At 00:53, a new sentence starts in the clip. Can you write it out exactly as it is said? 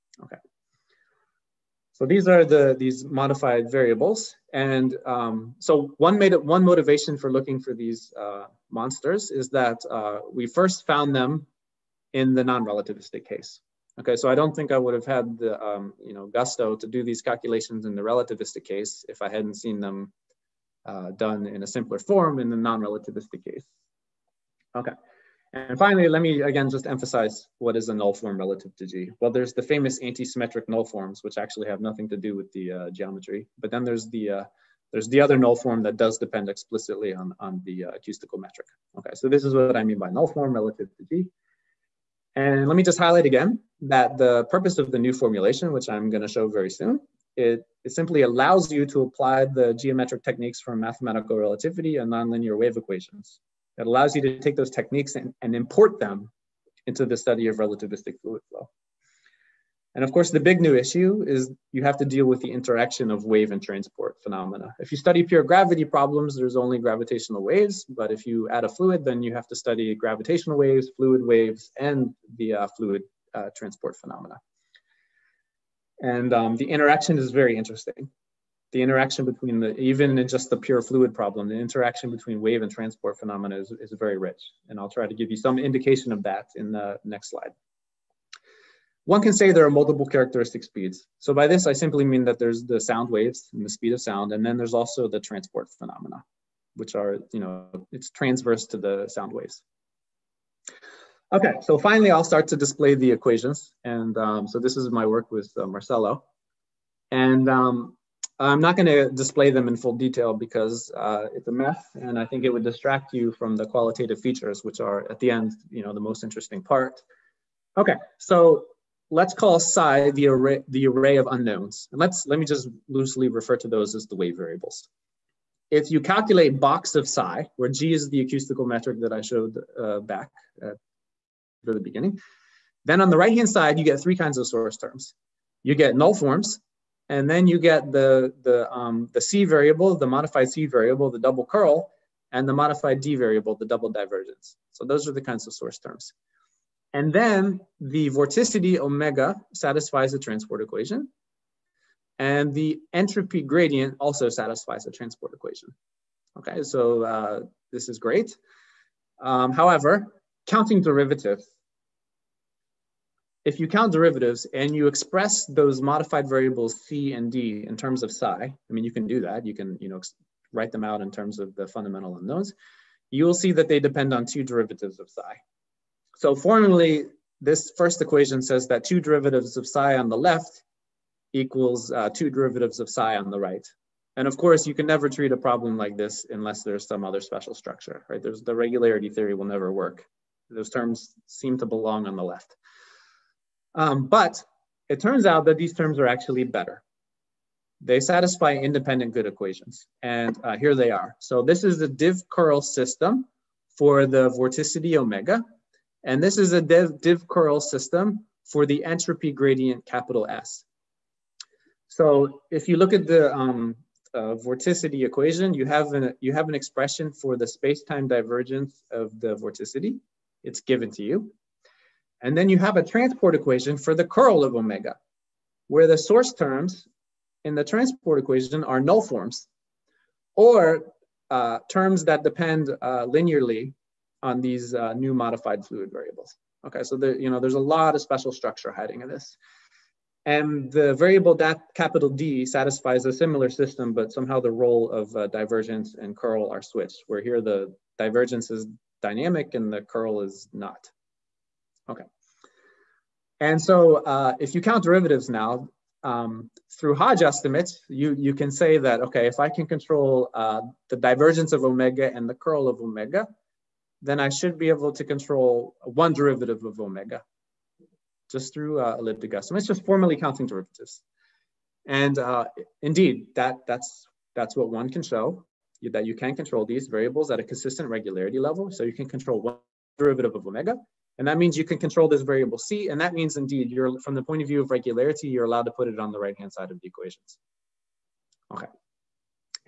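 It allows you to take those techniques and, and import them into the study of relativistic fluid flow.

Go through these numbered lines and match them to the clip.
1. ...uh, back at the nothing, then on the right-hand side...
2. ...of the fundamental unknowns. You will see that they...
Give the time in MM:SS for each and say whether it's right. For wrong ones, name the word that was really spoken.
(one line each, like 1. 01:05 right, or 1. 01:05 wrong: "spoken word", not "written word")
1. 02:09 wrong: "beginning", not "nothing"
2. 02:51 right.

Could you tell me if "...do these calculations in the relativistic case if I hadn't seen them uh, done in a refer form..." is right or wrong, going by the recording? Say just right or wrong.
wrong.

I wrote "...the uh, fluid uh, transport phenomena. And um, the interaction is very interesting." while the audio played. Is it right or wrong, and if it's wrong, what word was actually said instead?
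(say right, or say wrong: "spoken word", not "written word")
right.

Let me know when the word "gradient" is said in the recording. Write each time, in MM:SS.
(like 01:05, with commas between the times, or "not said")
02:33, 03:29.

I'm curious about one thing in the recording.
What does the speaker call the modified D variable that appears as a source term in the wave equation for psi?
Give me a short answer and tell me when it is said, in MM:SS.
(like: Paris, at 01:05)
Double divergence, at 02:23.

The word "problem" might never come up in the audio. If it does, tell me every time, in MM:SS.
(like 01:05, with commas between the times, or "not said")
01:05, 01:21, 03:05.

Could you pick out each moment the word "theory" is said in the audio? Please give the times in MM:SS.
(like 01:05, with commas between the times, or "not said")
03:09.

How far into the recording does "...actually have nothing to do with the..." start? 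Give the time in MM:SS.
00:31.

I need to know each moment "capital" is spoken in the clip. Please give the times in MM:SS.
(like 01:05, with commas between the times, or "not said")
03:29, 04:01.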